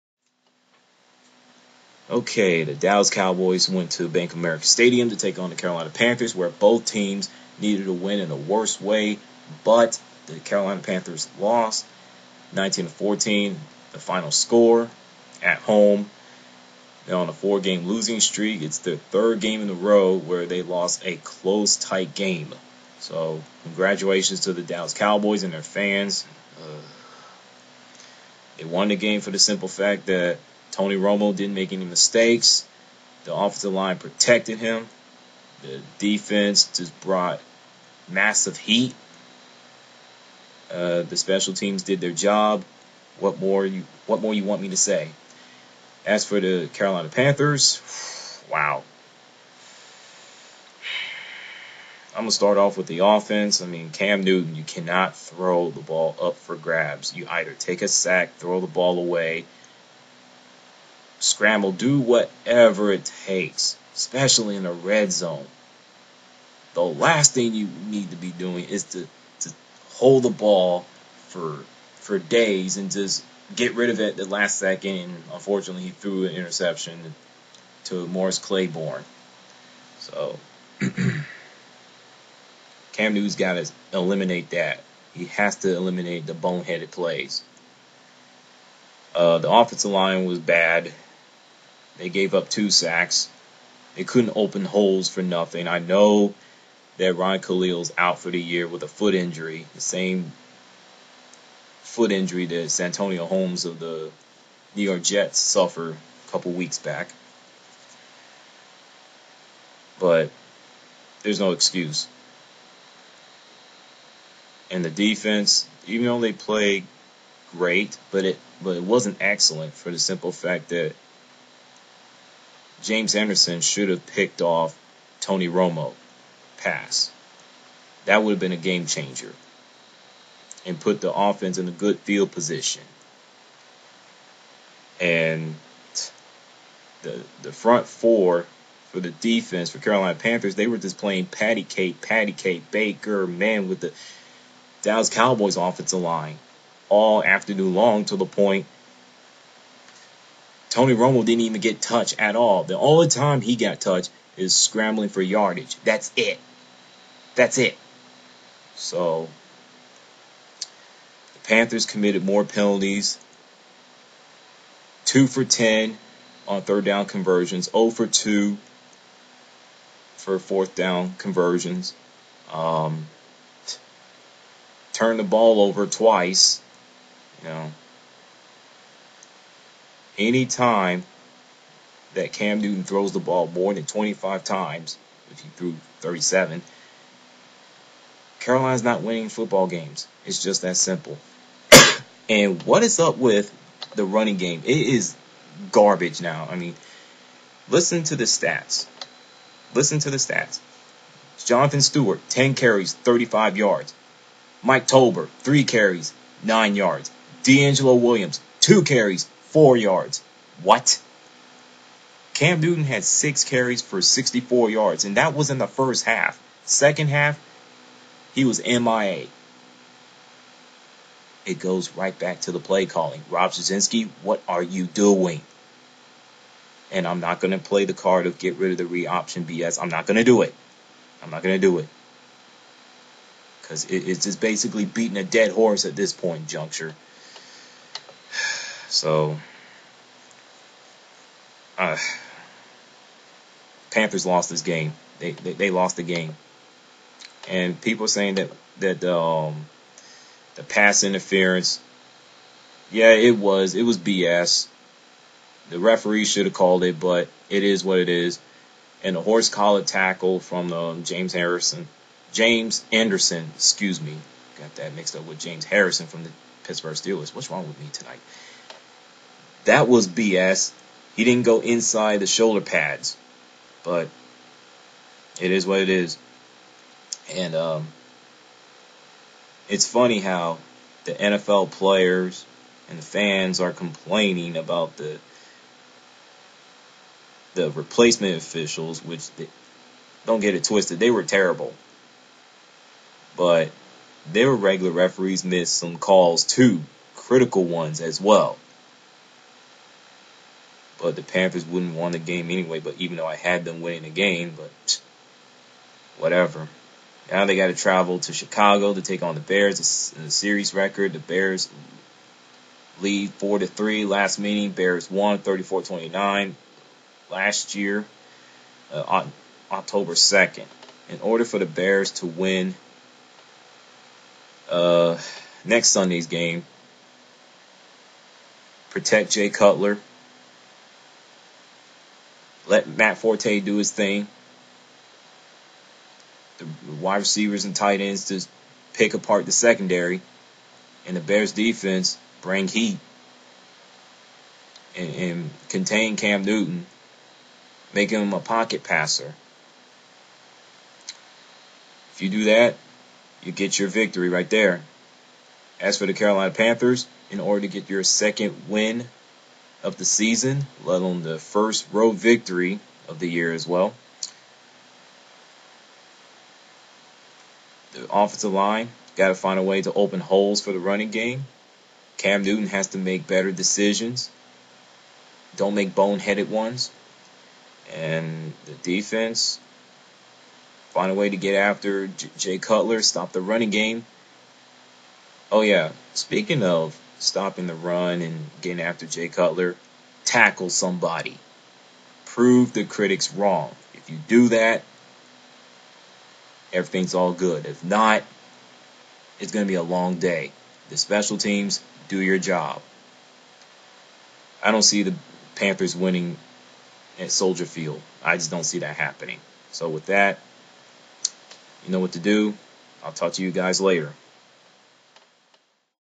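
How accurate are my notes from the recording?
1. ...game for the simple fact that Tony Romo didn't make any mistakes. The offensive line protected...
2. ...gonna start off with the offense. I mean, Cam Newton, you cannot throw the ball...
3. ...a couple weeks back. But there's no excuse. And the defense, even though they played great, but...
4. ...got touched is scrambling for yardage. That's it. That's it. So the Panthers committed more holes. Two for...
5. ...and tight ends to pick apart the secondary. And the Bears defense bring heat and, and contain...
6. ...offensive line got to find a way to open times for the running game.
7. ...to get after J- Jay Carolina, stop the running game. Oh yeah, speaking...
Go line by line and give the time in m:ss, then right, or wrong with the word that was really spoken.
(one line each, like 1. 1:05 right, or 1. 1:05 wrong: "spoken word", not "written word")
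1. 0:28 right
2. 0:52 right
3. 1:46 right
4. 2:33 wrong: "penalties", not "holes"
5. 5:37 right
6. 6:08 wrong: "holes", not "times"
7. 6:21 wrong: "Cutler", not "Carolina".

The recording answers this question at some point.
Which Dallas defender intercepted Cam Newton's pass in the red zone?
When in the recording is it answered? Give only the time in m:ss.
1:18.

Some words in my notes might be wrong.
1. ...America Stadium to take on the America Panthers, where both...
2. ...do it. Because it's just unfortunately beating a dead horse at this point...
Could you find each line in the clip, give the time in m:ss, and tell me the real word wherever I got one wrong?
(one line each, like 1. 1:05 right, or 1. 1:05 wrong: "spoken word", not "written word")
1. 0:04 wrong: "Carolina", not "America"
2. 3:51 wrong: "basically", not "unfortunately".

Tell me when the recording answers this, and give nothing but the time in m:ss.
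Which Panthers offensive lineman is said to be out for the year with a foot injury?
1:37.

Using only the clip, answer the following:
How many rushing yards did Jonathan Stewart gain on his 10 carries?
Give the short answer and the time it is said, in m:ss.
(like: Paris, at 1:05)
35 yards, at 3:22.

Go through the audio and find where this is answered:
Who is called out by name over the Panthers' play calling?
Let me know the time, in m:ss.
3:43.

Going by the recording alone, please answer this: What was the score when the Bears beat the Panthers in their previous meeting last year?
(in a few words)
34-29.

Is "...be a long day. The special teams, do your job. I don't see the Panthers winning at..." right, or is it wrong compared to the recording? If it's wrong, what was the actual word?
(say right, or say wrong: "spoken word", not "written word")
right.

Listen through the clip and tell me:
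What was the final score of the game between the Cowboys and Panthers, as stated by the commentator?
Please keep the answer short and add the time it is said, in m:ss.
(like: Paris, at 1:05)
19 to 14, at 0:12.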